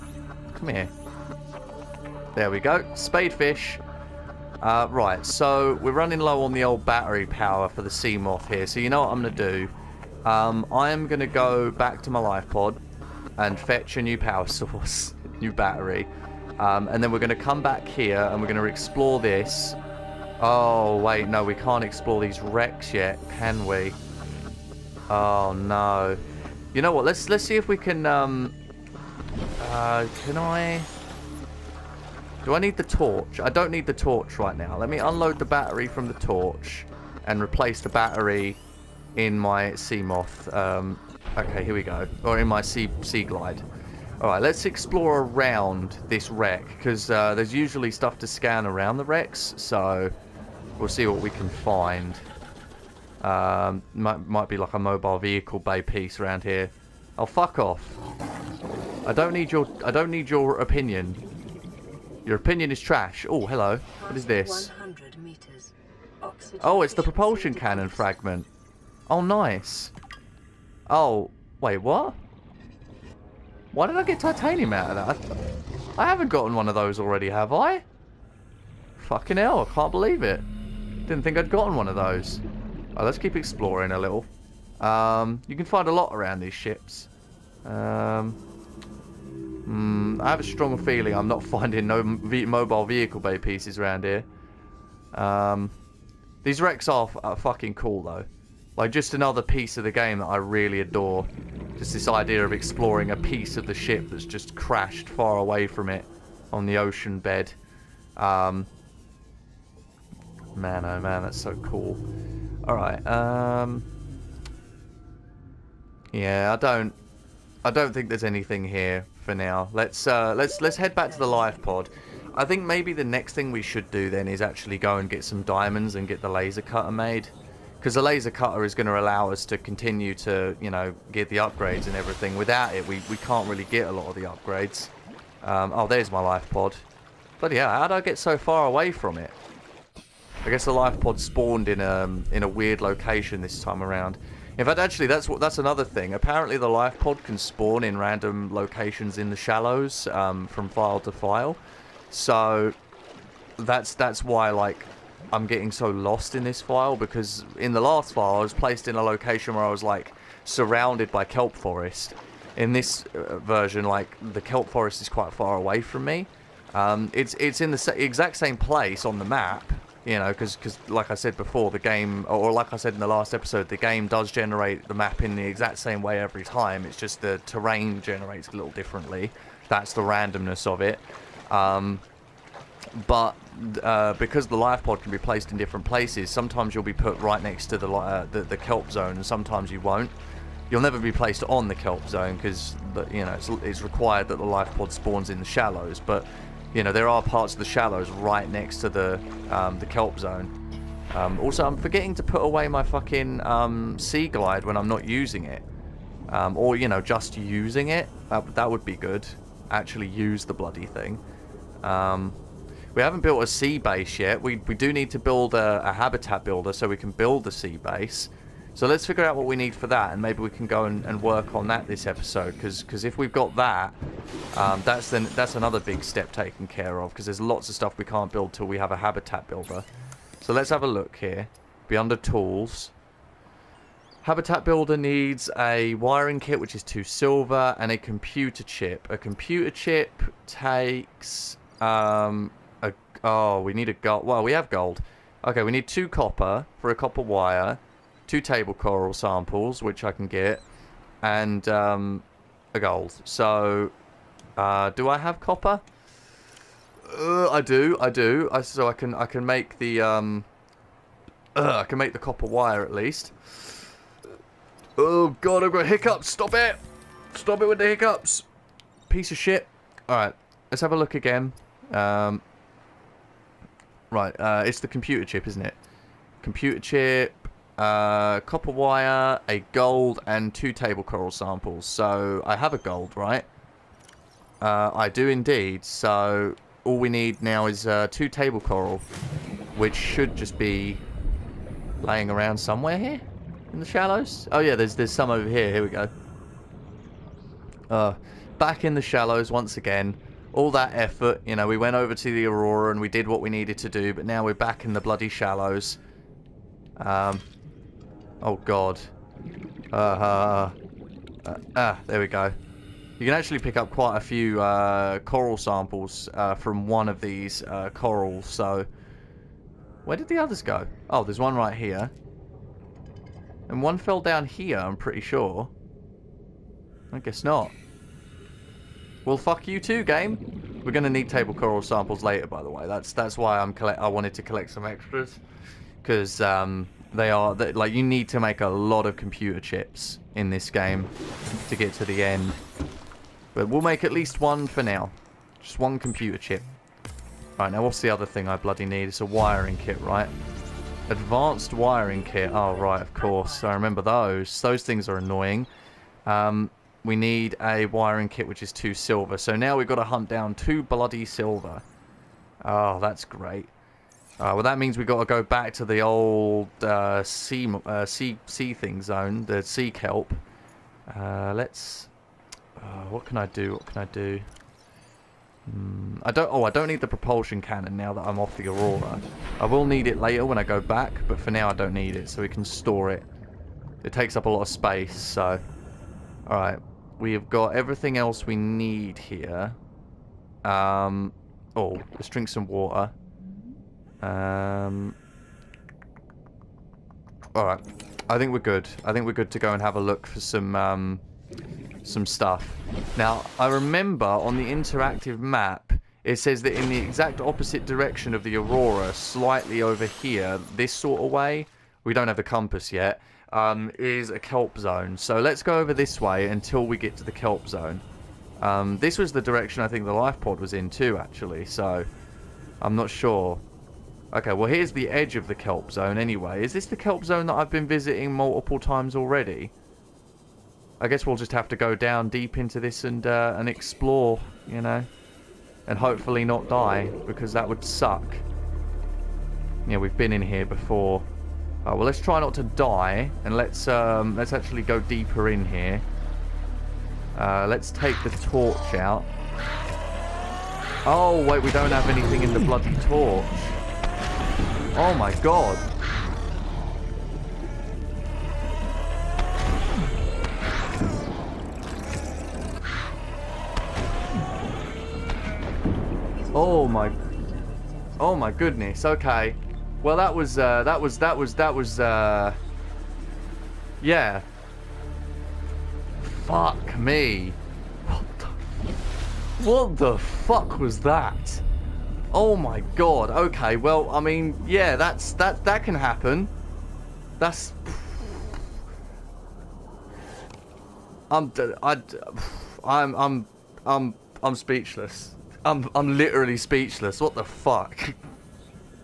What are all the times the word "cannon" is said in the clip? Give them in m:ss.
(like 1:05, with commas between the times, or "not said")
1:07, 6:17.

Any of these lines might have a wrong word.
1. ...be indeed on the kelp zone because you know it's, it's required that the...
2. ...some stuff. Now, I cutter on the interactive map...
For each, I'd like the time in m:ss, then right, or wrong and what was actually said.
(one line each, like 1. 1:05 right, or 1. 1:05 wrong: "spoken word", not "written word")
1. 3:10 wrong: "placed", not "indeed"
2. 6:42 wrong: "remember", not "cutter".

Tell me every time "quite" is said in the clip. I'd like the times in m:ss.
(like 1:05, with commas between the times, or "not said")
2:45, 5:13.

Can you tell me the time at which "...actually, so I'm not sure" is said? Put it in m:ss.
7:01.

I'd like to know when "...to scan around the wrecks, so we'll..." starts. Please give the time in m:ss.
0:48.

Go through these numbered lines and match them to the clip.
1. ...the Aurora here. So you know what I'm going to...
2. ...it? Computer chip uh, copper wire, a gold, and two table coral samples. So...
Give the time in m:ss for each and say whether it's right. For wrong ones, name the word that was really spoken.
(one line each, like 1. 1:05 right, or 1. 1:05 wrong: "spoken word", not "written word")
1. 0:07 wrong: "Seamoth", not "Aurora"
2. 4:35 right.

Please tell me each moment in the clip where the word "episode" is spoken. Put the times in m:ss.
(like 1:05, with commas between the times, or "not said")
2:53, 3:42.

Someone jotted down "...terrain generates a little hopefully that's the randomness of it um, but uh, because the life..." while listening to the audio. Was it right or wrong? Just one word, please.
wrong.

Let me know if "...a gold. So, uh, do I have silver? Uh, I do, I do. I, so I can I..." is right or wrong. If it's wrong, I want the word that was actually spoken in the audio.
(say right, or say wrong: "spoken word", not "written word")
wrong: "copper", not "silver".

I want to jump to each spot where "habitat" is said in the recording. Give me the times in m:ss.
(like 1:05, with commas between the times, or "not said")
3:35, 3:48, 3:54.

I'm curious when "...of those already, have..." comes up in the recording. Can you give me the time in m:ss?
1:16.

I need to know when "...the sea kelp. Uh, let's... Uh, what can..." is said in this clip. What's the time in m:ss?
6:09.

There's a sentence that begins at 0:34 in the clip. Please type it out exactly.
Let me unload the battery from the torch and replace the battery in my Seamoth.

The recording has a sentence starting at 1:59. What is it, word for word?
Let's uh, let's let's head back to the live pod.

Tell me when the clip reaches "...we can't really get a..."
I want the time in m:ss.
2:13.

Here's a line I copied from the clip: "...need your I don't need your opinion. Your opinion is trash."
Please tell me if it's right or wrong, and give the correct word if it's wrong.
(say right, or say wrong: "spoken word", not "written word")
right.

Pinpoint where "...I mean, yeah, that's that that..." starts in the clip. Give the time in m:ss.
8:04.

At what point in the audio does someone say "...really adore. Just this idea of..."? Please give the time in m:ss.
1:40.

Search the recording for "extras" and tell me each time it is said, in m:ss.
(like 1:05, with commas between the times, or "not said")
5:34.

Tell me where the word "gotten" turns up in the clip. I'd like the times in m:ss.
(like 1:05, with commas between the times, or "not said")
1:16, 1:21.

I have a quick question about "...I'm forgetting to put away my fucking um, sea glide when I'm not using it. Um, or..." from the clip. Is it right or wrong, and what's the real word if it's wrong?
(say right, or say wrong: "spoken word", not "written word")
right.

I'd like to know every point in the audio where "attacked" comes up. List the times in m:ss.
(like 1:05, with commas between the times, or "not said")
not said.